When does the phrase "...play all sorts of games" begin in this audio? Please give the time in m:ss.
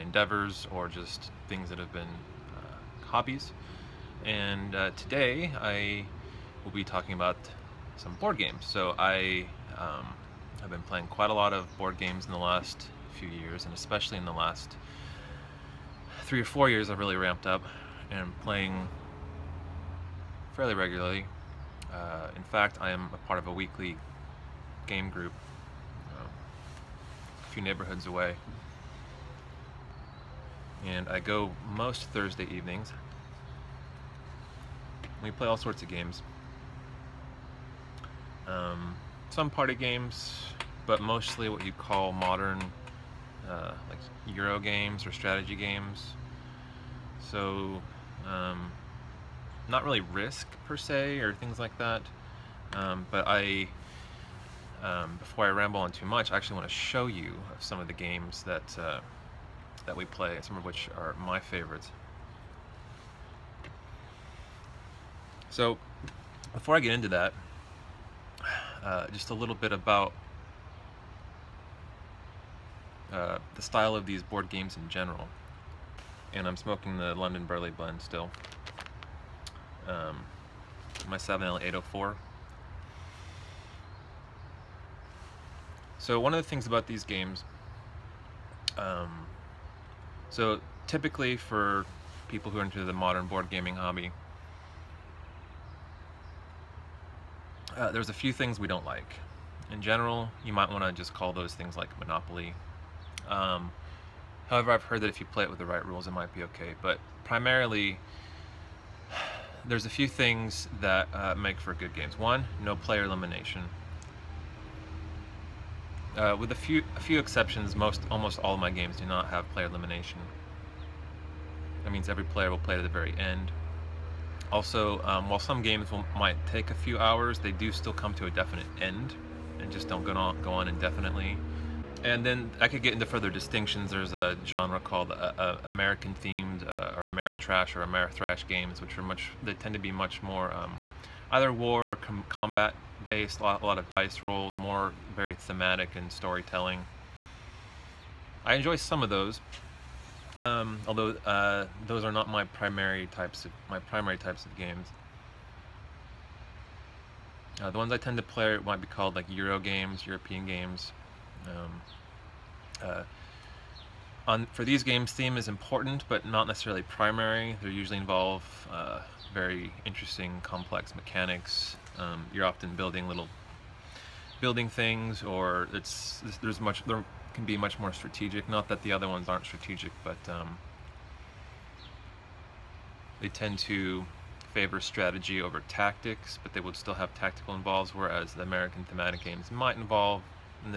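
0:35.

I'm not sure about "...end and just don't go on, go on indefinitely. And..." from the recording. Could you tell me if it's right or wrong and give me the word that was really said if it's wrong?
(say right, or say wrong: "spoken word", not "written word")
right.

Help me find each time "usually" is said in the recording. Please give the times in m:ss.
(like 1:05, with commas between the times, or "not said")
2:47.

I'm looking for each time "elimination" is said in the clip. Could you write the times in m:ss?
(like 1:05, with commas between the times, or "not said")
1:53, 1:59.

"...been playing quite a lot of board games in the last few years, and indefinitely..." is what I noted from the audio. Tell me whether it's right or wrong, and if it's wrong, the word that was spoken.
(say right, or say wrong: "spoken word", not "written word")
wrong: "especially", not "indefinitely".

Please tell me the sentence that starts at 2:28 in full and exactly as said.
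I enjoy some of those, um, although uh, those are not my primary types of my primary types of games.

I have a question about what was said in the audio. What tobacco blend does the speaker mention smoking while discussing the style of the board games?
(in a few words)
London Burley.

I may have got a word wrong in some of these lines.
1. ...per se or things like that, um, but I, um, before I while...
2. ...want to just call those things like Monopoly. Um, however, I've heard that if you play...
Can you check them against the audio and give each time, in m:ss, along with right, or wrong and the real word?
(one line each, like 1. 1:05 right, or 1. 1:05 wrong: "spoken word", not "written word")
1. 0:50 wrong: "ramble", not "while"
2. 1:40 right.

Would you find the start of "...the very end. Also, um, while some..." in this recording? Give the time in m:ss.
2:02.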